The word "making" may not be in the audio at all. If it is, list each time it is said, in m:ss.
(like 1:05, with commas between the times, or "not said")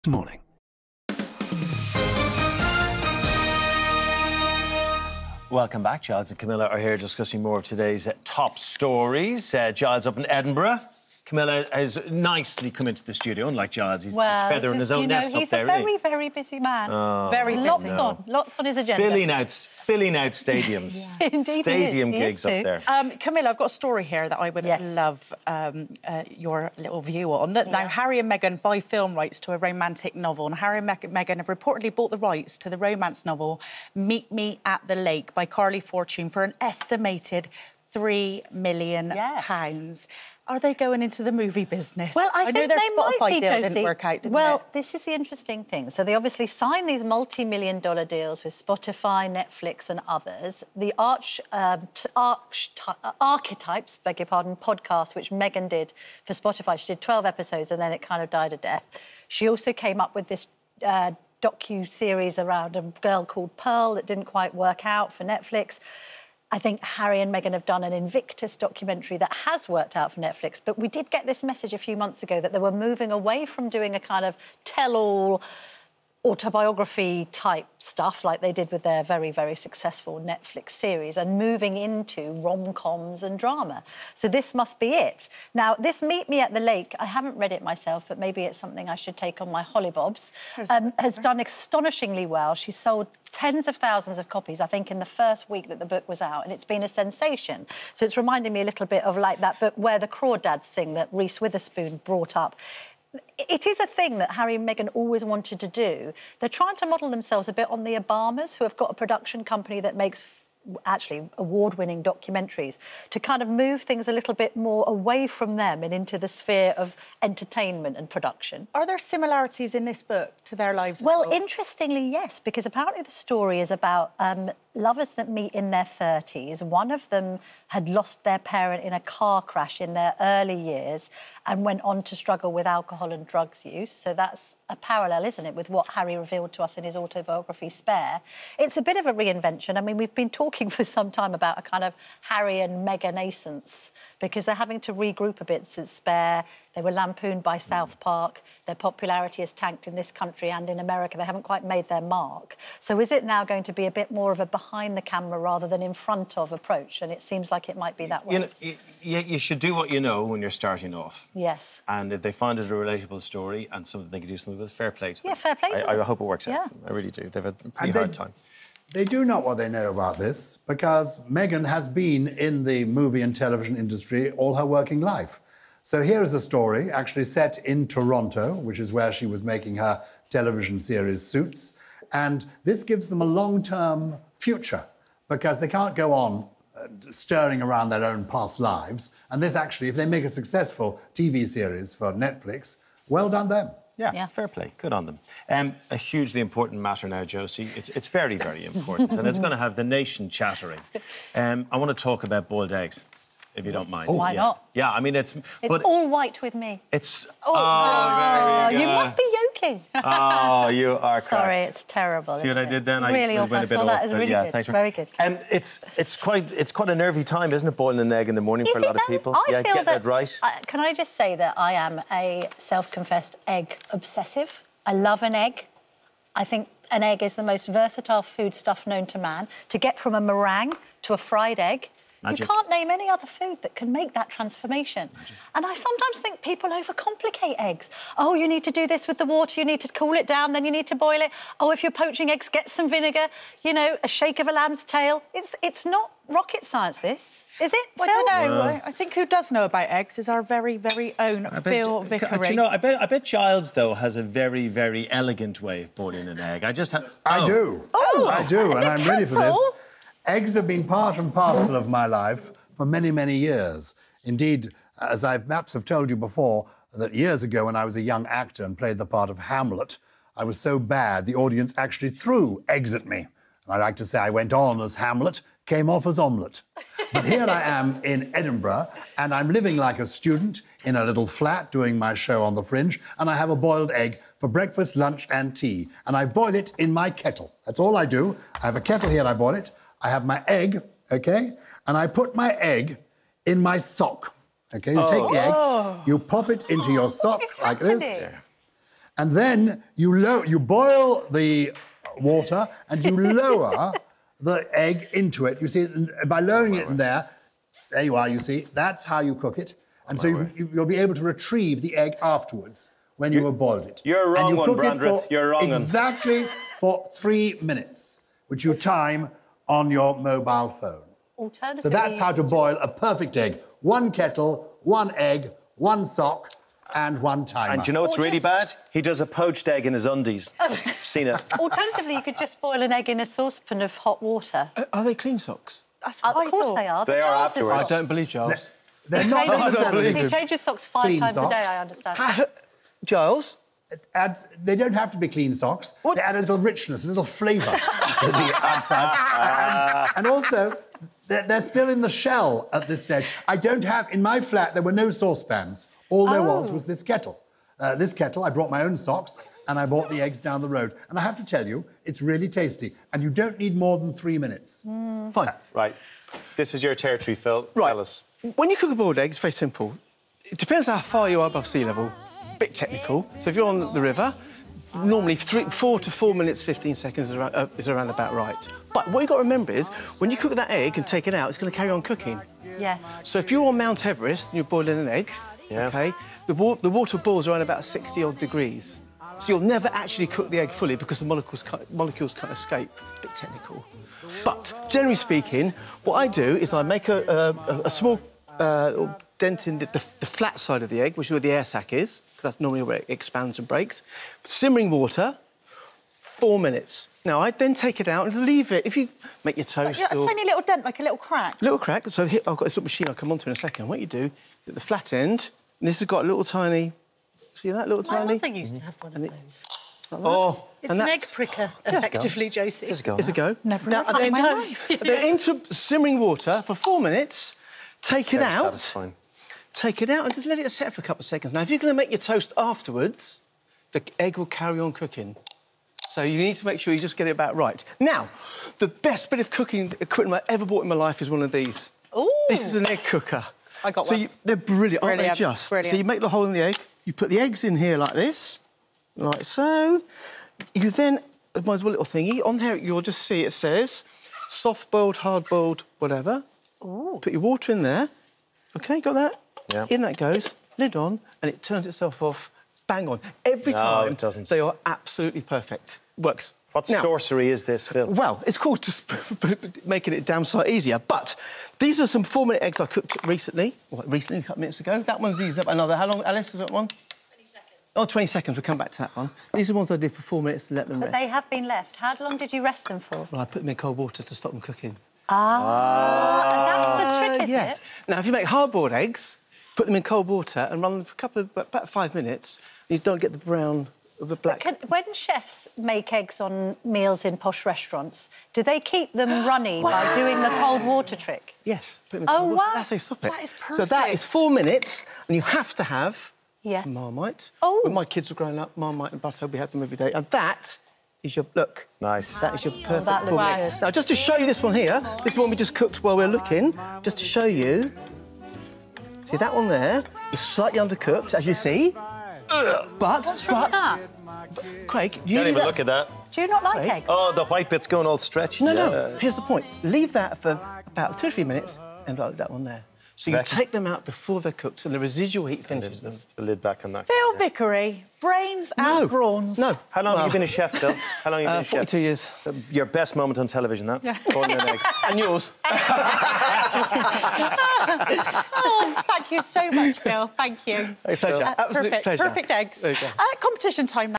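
2:59, 7:49.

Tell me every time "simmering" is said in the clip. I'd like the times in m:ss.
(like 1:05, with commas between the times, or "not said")
6:44, 7:05.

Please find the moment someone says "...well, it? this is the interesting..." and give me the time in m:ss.
0:44.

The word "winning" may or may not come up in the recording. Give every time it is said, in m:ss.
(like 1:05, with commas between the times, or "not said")
1:51.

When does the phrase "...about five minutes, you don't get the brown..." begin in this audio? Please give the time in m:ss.
8:11.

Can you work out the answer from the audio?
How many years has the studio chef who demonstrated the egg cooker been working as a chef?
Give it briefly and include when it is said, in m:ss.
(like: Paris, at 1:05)
42, at 9:02.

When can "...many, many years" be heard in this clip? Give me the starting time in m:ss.
4:22.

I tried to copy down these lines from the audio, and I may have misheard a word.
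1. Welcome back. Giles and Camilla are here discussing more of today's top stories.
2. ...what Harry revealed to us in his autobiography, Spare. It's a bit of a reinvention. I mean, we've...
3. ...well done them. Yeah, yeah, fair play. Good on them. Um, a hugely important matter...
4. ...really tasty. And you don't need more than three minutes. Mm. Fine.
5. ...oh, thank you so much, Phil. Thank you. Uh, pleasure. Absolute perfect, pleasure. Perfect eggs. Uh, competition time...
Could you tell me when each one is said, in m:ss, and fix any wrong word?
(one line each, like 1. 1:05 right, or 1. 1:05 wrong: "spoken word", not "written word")
1. 0:05 right
2. 2:15 right
3. 3:13 right
4. 6:02 right
5. 9:08 right.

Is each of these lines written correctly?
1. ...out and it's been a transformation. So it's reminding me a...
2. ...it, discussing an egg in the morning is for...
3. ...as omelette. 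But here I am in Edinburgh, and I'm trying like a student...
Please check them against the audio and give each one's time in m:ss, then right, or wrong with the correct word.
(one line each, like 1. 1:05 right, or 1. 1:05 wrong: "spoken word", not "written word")
1. 1:36 wrong: "sensation", not "transformation"
2. 3:37 wrong: "boiling", not "discussing"
3. 4:36 wrong: "living", not "trying".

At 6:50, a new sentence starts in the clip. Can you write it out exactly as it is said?
A tiny little dent, like a little crack.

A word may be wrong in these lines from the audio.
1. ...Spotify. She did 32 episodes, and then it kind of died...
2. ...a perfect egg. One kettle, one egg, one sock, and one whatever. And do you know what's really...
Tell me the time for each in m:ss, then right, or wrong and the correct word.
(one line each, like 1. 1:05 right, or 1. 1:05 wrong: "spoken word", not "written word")
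1. 0:56 wrong: "12", not "32"
2. 5:22 wrong: "timer", not "whatever".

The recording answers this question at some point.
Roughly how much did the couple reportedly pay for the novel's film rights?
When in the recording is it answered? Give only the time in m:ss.
0:37.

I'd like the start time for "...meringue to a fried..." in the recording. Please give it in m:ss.
3:50.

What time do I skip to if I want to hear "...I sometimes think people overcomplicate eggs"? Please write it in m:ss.
3:55.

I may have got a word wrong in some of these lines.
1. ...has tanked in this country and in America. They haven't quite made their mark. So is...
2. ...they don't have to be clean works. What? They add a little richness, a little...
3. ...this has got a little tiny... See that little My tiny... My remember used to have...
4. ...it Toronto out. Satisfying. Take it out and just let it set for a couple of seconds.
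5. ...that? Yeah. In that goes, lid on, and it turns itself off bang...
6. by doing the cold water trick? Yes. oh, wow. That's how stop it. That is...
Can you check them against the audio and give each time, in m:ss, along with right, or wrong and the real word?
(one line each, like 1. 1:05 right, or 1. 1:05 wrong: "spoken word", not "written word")
1. 2:29 right
2. 5:44 wrong: "socks", not "works"
3. 6:55 wrong: "mother", not "remember"
4. 7:08 wrong: "Very", not "Toronto"
5. 7:39 right
6. 8:19 right.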